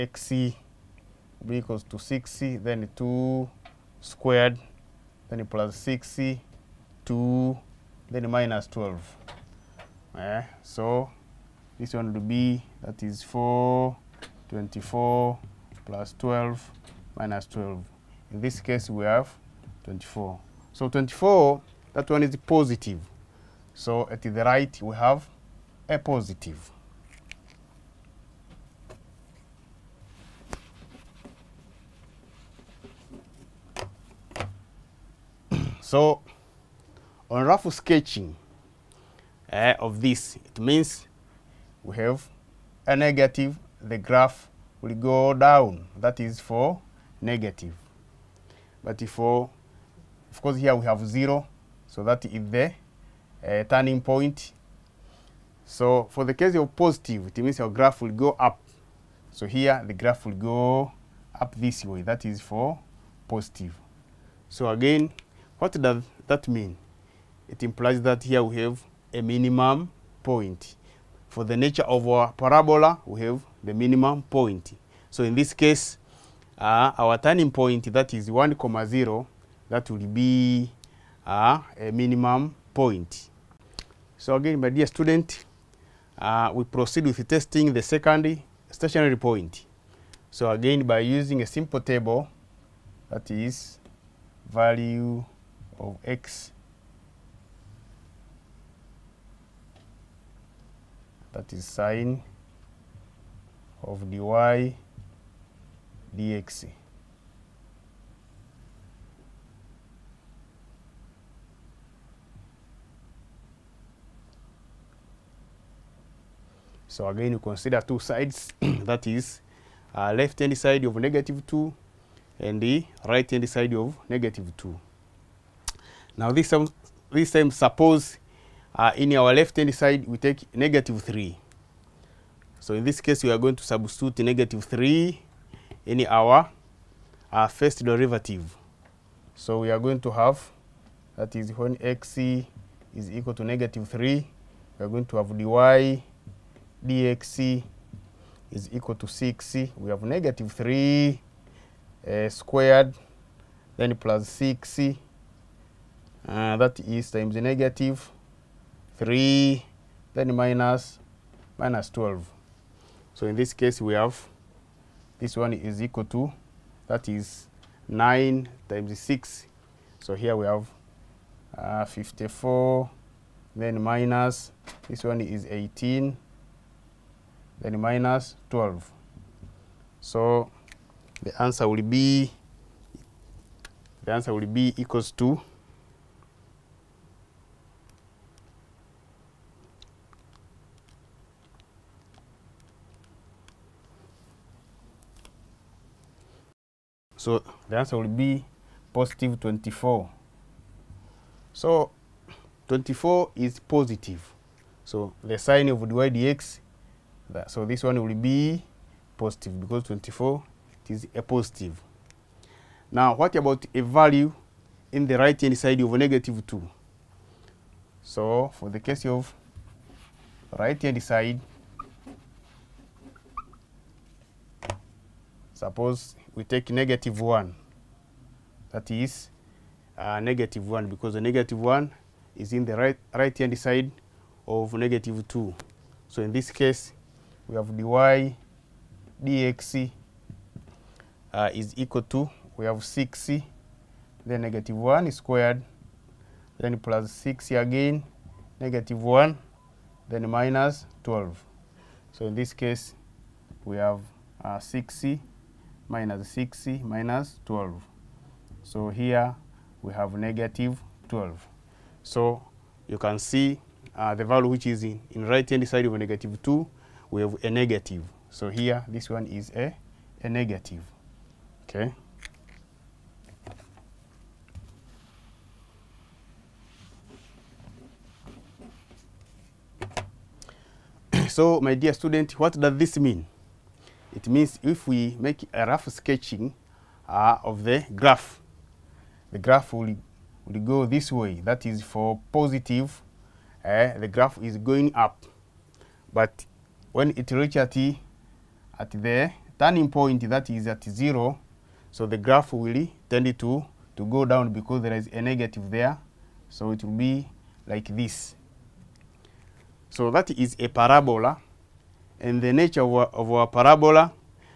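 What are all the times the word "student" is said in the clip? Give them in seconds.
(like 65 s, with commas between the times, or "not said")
84 s, 281 s.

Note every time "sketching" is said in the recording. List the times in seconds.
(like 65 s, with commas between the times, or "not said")
37 s, 285 s.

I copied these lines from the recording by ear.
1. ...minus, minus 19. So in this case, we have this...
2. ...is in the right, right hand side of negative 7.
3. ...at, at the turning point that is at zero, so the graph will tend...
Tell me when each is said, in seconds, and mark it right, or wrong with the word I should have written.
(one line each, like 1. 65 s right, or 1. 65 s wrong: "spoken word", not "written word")
1. 160 s wrong: "12", not "19"
2. 232 s wrong: "2", not "7"
3. 297 s right.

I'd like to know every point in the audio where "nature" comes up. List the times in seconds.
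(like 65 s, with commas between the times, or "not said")
71 s, 312 s.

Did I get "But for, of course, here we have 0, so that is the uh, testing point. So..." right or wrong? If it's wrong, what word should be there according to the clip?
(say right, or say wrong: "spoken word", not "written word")
wrong: "turning", not "testing".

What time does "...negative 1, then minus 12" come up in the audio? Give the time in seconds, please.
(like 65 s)
248 s.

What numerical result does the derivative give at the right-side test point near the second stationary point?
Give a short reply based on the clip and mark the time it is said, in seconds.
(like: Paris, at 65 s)
-12, at 260 s.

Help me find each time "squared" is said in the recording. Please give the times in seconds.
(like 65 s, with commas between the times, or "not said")
4 s, 152 s, 245 s.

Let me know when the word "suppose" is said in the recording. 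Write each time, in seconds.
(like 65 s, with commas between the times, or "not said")
127 s, 225 s.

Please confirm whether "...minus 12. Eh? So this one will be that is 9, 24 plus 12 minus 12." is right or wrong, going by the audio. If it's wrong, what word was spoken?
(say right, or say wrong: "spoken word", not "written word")
wrong: "4", not "9".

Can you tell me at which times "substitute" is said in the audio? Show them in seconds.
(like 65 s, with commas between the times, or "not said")
133 s.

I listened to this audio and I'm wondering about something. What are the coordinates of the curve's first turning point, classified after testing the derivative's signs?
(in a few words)
(1, 0).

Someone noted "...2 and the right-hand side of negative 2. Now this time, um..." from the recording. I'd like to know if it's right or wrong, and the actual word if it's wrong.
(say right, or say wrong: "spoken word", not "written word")
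right.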